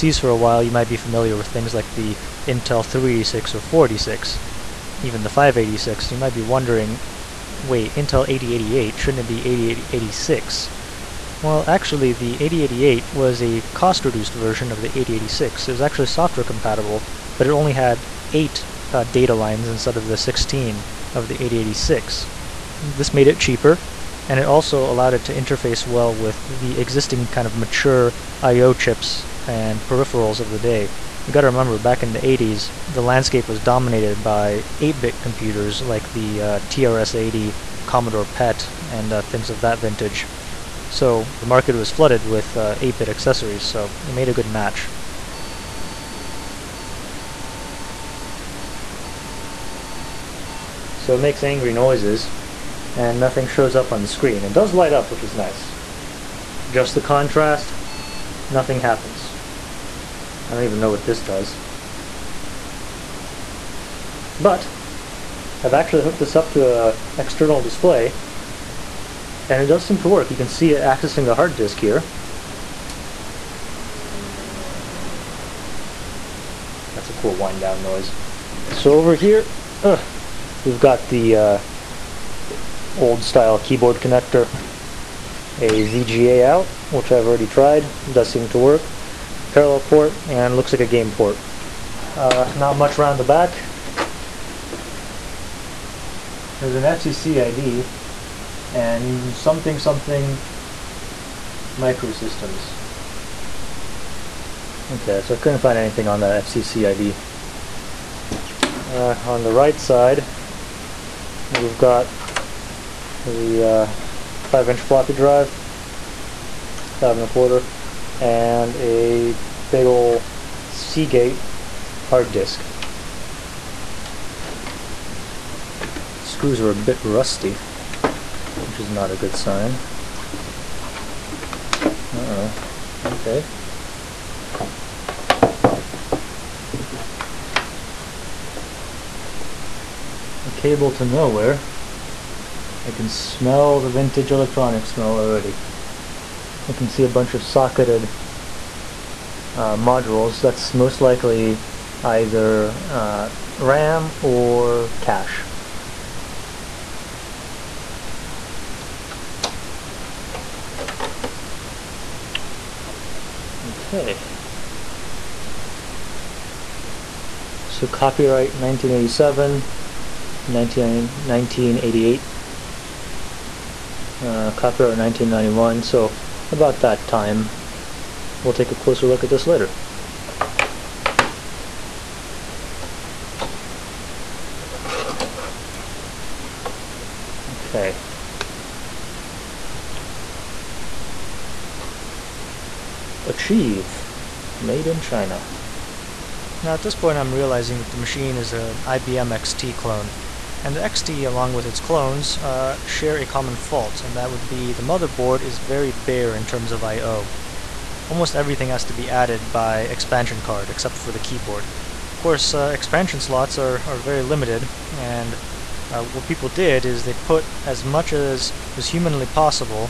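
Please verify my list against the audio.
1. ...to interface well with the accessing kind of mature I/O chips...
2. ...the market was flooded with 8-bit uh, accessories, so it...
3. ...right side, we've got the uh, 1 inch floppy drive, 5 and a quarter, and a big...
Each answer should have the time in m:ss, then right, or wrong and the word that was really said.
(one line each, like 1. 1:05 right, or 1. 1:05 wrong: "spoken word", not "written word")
1. 0:25 wrong: "existing", not "accessing"
2. 0:41 right
3. 1:49 wrong: "5", not "1".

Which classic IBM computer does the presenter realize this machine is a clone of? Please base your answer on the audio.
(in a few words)
IBM XT.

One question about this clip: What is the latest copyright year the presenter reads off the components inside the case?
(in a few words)
1991.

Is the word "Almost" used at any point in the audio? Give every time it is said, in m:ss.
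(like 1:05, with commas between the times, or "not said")
3:28.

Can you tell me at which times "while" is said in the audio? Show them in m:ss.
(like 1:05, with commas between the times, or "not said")
0:00.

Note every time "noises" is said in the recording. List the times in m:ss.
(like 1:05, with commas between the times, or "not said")
0:51, 1:17.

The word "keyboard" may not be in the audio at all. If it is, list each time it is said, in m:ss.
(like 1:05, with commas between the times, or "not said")
1:23, 3:31.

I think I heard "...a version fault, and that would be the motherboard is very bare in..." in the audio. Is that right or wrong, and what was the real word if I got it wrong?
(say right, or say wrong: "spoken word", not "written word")
wrong: "common", not "version".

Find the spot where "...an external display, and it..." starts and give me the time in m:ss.
1:06.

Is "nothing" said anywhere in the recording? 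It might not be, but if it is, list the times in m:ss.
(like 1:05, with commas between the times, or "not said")
0:53, 0:58.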